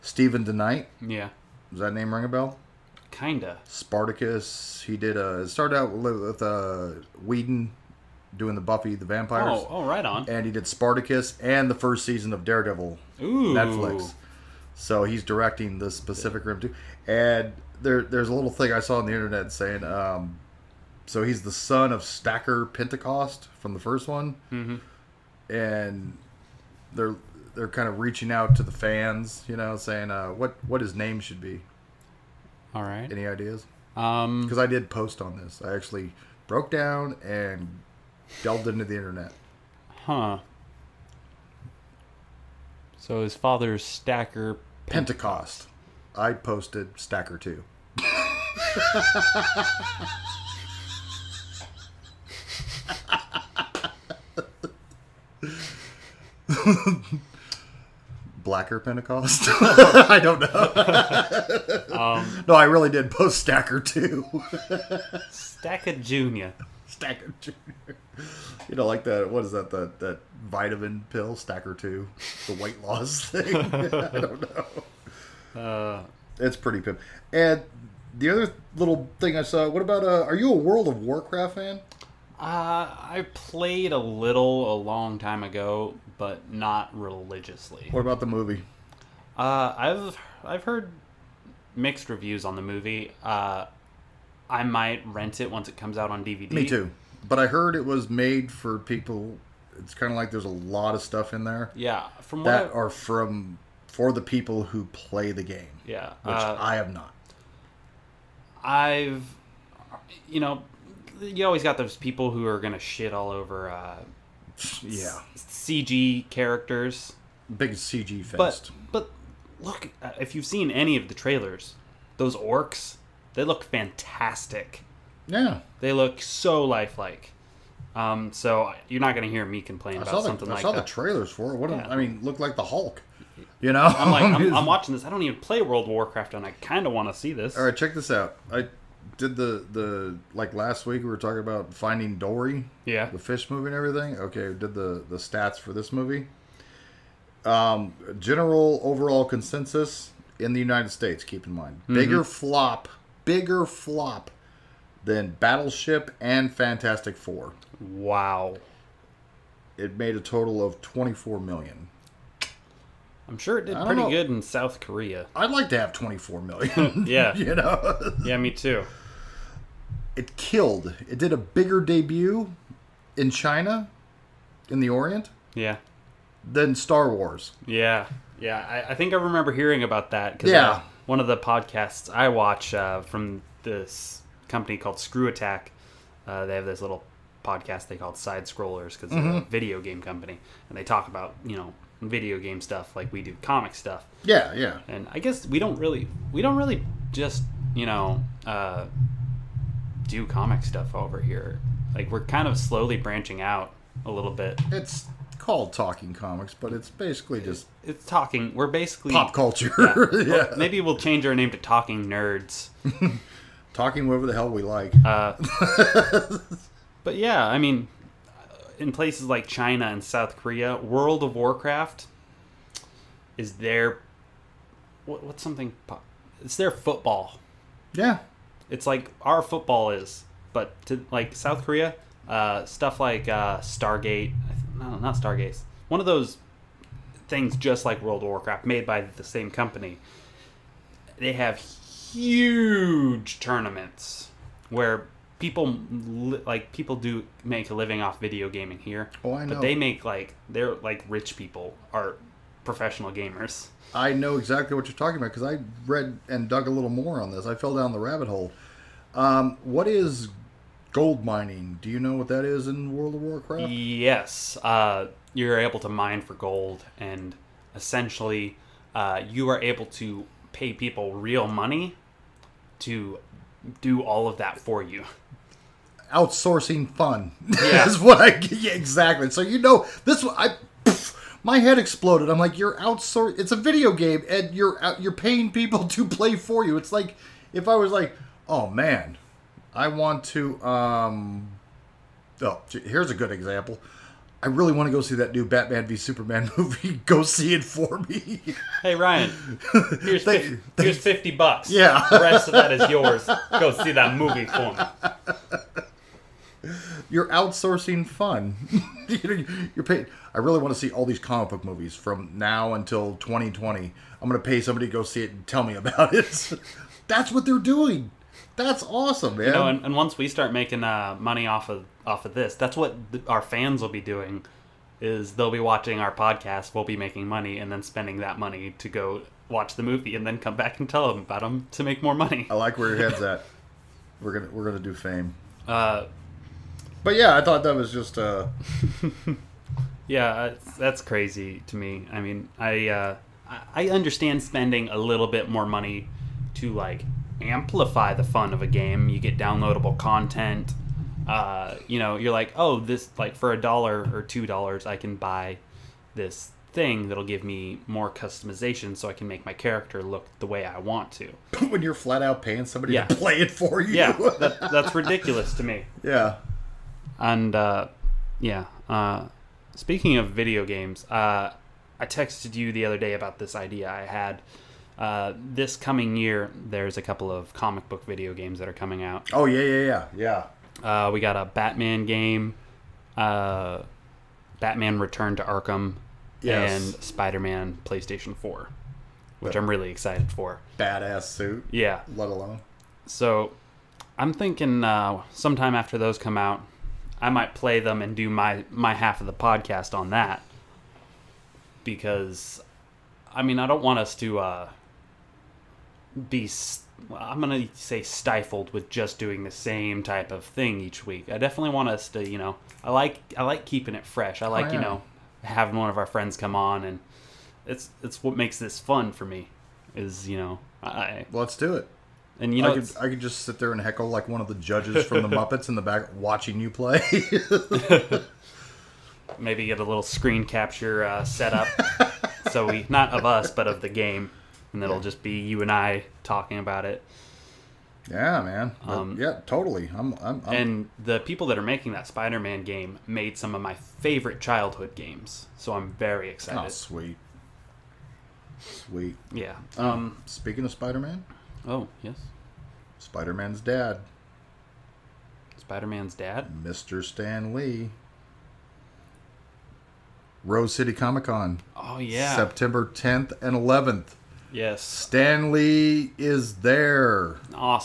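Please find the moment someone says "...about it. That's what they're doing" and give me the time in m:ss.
5:15.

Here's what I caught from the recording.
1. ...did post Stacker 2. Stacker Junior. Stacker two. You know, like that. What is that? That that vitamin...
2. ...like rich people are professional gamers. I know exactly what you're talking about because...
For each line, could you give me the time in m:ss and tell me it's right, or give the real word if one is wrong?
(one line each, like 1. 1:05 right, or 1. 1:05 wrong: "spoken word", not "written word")
1. 1:02 right
2. 4:10 right.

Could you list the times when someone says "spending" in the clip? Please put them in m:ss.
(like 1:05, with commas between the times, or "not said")
5:27, 5:44.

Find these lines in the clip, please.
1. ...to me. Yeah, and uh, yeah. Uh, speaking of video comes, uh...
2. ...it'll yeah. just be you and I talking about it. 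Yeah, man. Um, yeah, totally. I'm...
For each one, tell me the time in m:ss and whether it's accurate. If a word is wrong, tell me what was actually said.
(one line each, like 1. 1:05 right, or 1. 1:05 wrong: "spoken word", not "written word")
1. 6:05 wrong: "games", not "comes"
2. 7:14 right.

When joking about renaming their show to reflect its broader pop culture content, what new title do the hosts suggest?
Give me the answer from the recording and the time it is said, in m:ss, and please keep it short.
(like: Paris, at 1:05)
Talking Nerds, at 3:31.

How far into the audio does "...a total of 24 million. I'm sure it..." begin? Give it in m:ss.
2:40.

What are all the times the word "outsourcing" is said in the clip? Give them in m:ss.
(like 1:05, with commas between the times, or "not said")
4:36, 4:42, 5:07.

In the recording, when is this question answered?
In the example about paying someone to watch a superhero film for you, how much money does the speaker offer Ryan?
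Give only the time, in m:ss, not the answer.
5:00.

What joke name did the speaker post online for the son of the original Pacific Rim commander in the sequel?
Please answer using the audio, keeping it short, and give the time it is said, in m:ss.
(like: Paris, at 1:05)
Stacker 2, at 0:46.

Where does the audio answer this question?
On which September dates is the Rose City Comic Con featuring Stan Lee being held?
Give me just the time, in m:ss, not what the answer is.
7:42.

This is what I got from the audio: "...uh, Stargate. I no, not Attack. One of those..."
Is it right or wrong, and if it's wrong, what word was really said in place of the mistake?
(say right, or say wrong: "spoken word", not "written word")
wrong: "Stargaze", not "Attack".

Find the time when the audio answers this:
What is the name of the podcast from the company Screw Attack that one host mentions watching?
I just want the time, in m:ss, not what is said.
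3:08.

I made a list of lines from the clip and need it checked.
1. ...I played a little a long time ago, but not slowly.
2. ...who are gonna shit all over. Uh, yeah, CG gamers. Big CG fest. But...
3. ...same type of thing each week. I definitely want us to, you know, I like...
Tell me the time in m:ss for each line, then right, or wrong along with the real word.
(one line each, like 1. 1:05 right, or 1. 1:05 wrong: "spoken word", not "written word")
1. 1:23 wrong: "religiously", not "slowly"
2. 1:52 wrong: "characters", not "gamers"
3. 6:49 right.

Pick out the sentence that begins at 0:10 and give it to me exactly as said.
And he did Spartacus and the first season of Daredevil.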